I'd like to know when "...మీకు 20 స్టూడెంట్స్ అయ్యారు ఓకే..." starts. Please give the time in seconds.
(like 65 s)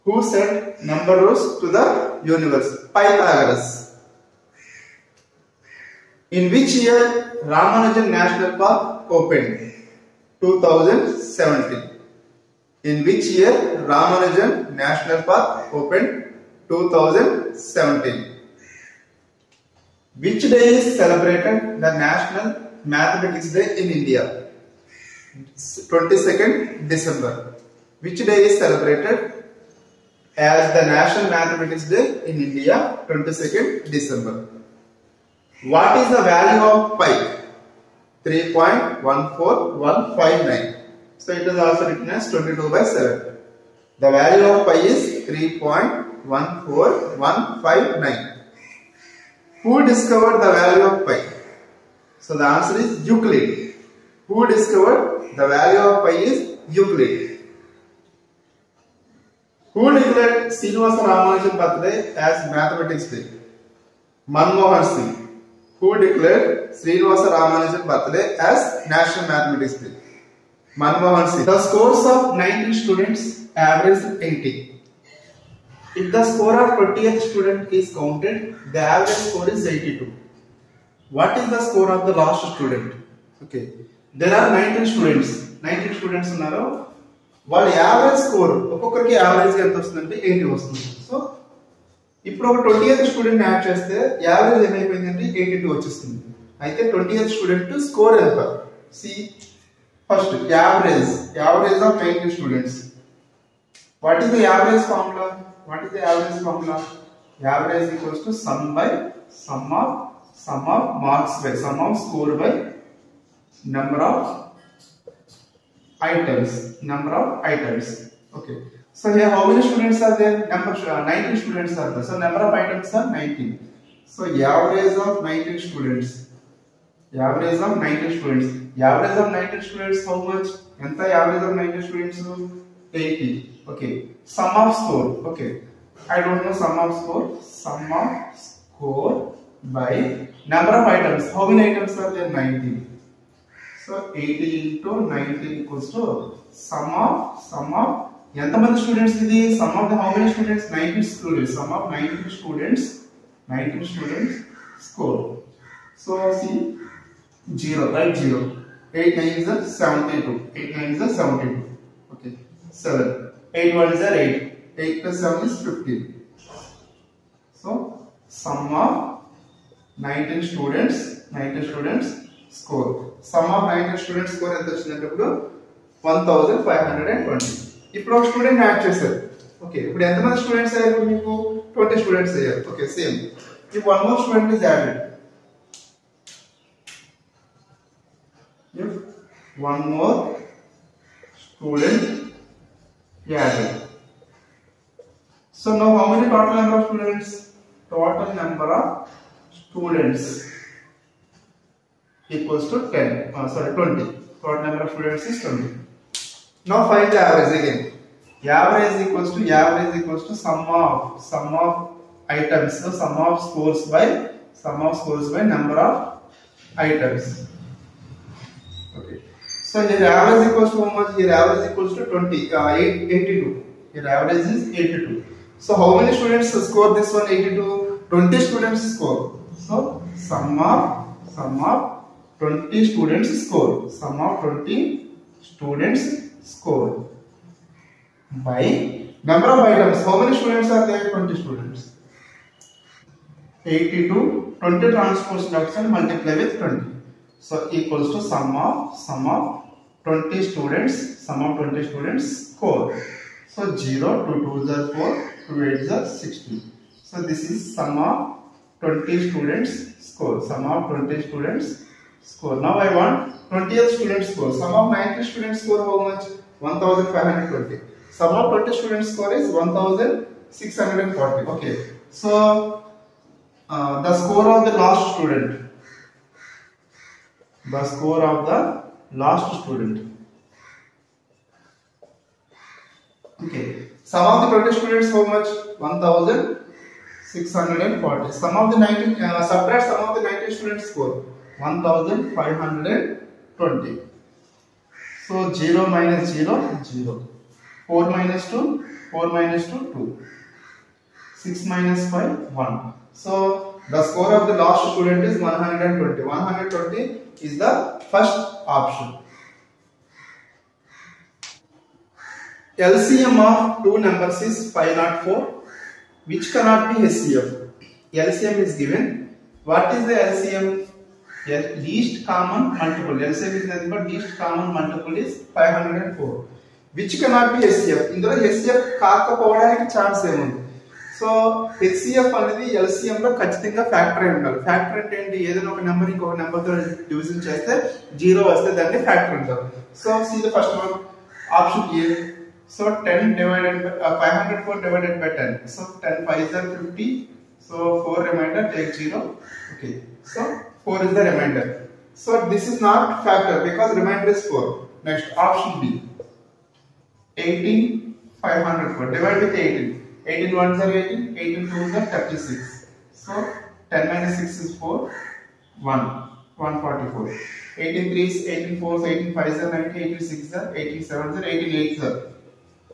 181 s.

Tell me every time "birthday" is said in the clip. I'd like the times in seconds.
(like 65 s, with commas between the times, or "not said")
61 s, 67 s.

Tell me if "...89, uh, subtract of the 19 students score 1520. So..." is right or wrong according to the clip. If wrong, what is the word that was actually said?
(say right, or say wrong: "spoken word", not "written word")
wrong: "19", not "89".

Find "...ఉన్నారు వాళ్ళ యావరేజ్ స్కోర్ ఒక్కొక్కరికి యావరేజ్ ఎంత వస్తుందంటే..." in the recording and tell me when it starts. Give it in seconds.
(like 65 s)
86 s.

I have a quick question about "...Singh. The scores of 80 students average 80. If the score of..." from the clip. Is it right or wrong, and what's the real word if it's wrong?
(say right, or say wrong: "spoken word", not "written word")
wrong: "90", not "80".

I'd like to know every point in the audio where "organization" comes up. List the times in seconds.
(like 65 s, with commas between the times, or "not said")
not said.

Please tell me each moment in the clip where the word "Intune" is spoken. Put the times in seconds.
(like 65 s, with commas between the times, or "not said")
not said.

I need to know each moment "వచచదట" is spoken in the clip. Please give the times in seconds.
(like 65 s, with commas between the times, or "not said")
174 s.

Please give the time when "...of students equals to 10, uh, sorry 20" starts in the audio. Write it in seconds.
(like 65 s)
198 s.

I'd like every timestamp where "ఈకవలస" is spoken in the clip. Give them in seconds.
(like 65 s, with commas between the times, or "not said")
145 s.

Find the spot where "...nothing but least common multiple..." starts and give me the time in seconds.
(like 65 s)
323 s.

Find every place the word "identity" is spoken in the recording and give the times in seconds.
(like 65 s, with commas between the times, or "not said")
not said.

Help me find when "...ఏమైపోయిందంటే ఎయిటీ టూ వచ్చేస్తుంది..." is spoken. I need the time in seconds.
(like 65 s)
94 s.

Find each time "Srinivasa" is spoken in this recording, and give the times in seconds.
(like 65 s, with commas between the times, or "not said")
60 s, 66 s.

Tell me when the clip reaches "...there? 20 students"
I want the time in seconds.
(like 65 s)
240 s.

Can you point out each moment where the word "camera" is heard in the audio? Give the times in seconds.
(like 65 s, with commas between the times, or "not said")
not said.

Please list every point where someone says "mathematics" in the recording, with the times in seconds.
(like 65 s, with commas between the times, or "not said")
22 s, 31 s, 62 s, 69 s.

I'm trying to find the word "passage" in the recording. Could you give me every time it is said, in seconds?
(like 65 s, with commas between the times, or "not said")
not said.